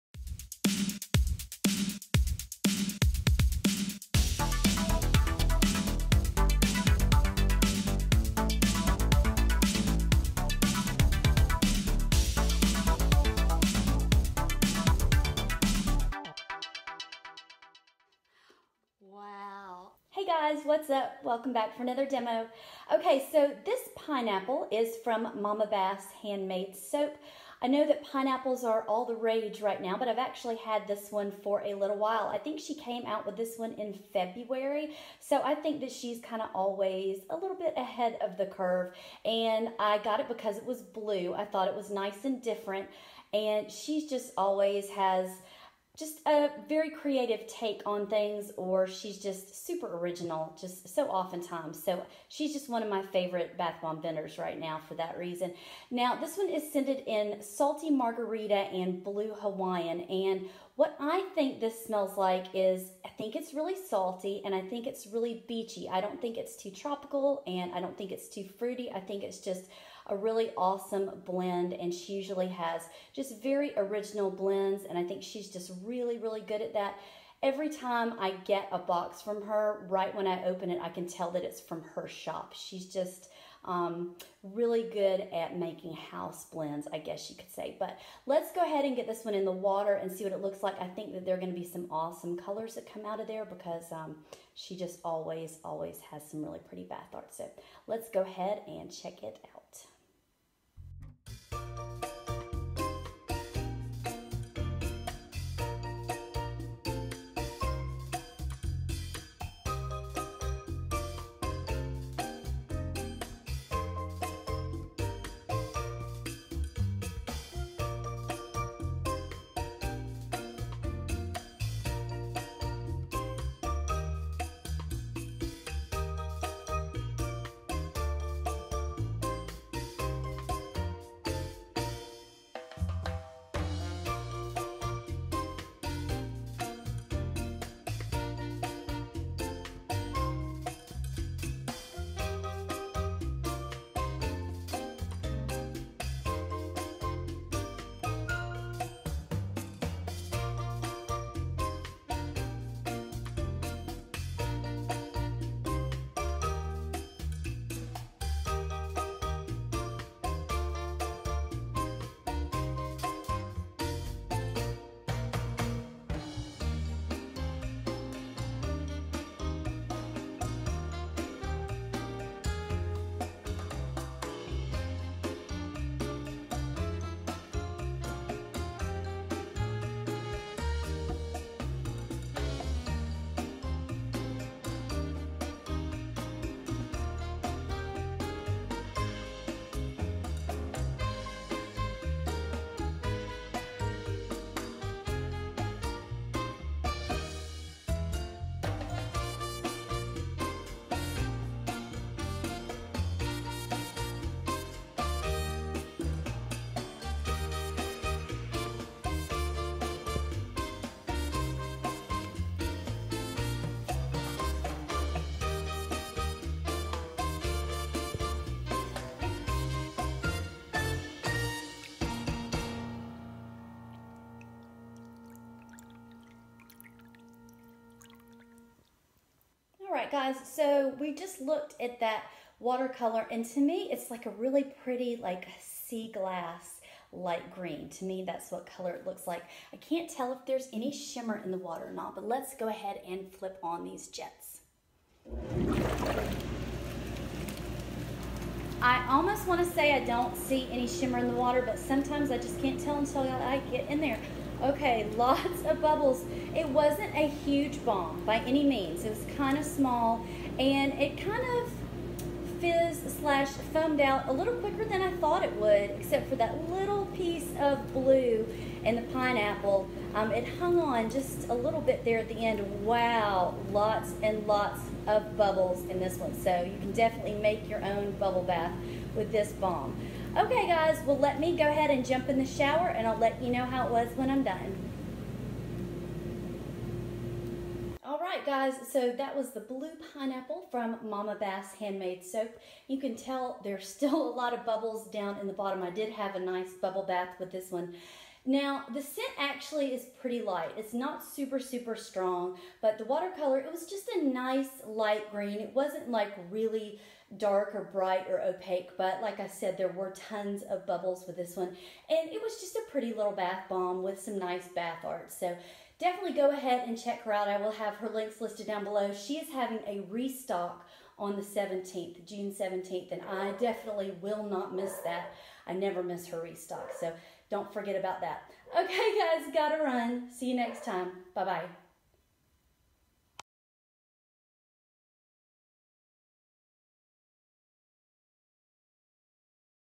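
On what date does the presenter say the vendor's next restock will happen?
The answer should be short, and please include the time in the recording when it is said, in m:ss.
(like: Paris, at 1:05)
June 17th, at 5:22.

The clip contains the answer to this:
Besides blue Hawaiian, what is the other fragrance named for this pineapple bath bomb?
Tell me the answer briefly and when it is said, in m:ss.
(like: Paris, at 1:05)
salty margarita, at 0:57.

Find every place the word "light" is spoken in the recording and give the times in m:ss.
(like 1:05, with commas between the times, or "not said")
3:57, 5:00, 5:04.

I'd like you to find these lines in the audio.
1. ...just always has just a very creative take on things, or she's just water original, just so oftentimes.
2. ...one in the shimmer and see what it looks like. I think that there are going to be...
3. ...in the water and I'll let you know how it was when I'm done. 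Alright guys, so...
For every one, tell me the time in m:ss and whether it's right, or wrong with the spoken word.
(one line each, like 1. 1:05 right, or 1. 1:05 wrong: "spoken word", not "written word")
1. 0:44 wrong: "super", not "water"
2. 1:29 wrong: "water", not "shimmer"
3. 4:42 wrong: "shower", not "water".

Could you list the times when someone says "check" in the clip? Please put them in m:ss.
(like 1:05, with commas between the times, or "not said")
1:38, 5:17.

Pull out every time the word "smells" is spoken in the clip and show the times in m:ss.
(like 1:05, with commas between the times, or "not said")
1:01.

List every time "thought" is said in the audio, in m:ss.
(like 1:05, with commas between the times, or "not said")
0:41, 4:25.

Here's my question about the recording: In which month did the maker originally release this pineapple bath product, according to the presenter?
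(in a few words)
February.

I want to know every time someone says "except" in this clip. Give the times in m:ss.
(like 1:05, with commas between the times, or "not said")
4:25.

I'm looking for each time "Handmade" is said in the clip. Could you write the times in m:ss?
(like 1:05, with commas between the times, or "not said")
0:26, 4:51.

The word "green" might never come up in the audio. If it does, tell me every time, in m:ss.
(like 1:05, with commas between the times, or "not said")
3:57, 5:05.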